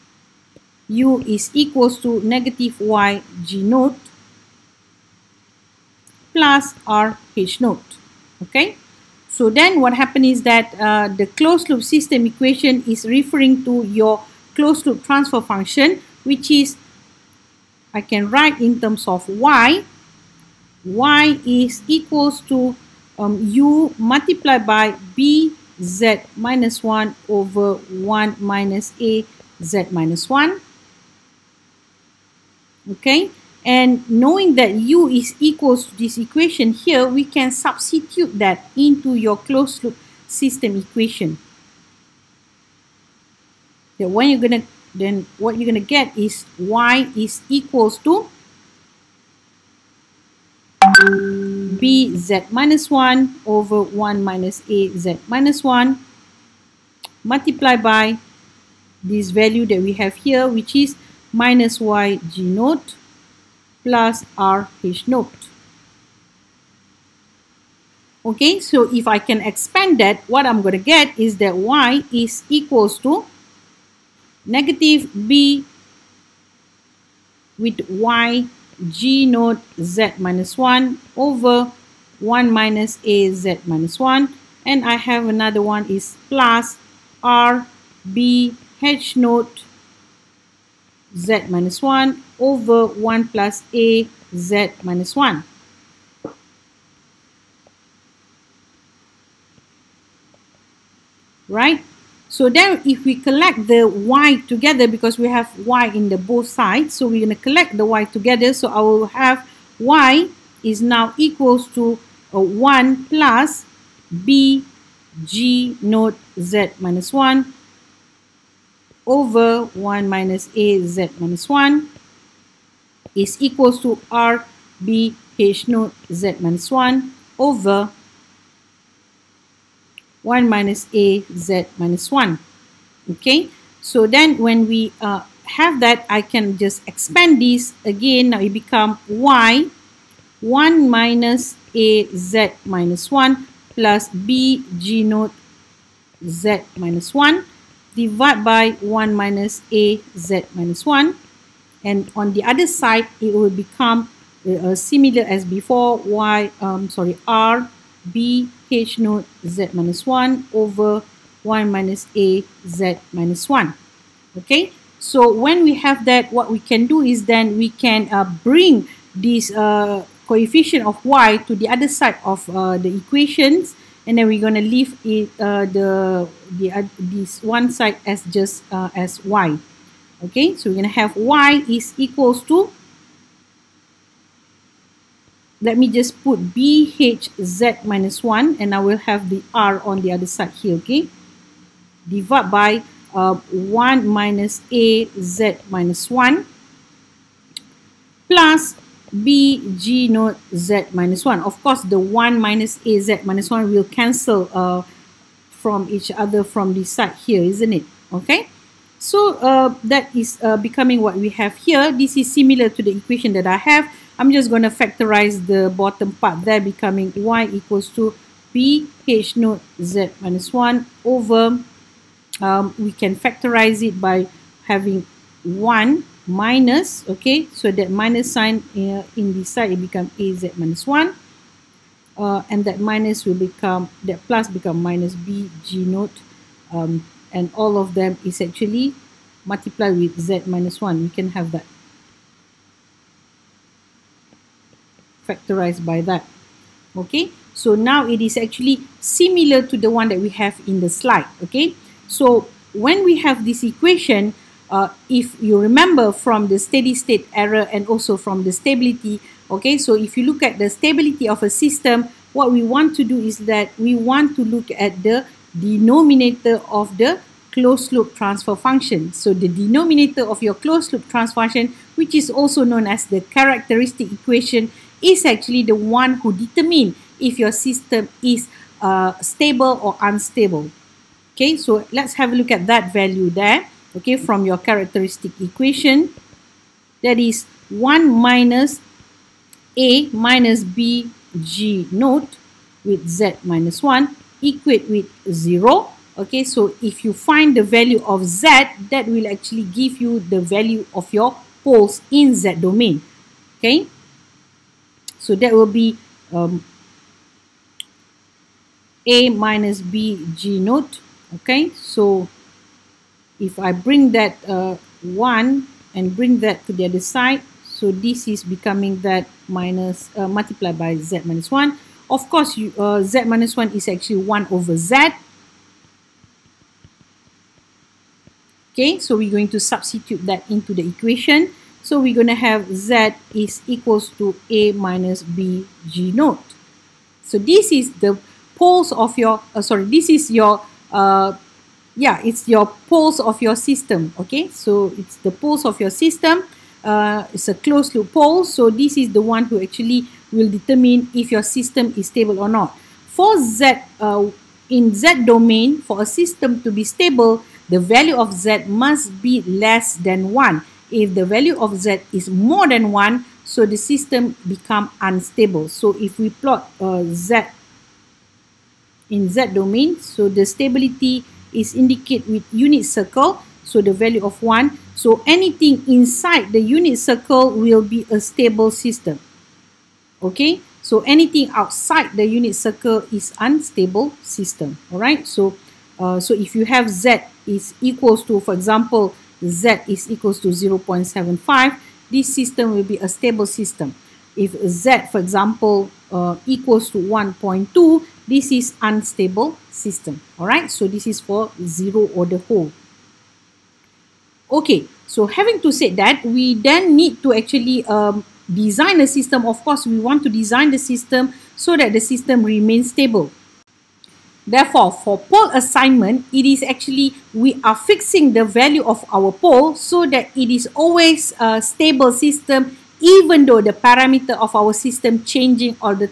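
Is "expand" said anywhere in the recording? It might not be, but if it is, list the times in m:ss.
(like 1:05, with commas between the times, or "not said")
1:09, 2:16.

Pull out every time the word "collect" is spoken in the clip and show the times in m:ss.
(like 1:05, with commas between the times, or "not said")
1:43, 1:47.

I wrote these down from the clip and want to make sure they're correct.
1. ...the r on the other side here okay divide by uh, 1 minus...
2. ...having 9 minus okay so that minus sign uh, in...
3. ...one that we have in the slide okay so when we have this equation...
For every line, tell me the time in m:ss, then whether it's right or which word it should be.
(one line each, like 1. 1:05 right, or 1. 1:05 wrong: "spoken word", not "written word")
1. 3:09 right
2. 3:44 wrong: "1", not "9"
3. 4:09 right.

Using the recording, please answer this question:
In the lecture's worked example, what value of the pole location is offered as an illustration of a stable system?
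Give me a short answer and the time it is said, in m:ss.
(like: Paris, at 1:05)
0.75, at 6:30.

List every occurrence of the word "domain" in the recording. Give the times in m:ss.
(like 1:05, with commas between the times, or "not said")
5:02, 5:55, 6:09.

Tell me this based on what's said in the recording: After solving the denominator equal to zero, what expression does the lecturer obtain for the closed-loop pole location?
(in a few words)
a minus b g naught.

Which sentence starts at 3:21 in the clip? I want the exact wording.
Of course, the 1 minus A Z minus 1 will cancel uh, from each other from this side here, isn't it?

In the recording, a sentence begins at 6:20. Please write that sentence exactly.
Okay, so anything outside the unit circle is unstable system.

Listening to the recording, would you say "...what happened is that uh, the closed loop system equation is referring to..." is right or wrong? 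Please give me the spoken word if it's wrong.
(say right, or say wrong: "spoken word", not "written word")
right.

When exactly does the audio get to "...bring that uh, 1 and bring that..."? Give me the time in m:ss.
5:13.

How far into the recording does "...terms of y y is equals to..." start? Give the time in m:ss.
0:18.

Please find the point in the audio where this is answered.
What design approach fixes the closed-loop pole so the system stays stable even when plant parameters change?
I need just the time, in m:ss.
6:55.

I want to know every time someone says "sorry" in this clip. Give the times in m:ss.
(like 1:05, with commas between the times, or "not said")
2:36, 5:39.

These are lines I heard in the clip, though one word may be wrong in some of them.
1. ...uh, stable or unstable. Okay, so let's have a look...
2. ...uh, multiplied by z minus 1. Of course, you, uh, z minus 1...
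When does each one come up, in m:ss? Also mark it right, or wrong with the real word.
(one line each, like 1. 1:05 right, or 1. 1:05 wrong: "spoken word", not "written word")
1. 4:38 right
2. 5:20 right.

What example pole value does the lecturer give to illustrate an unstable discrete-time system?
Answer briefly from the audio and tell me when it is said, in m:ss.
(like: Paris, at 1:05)
1.2, at 6:36.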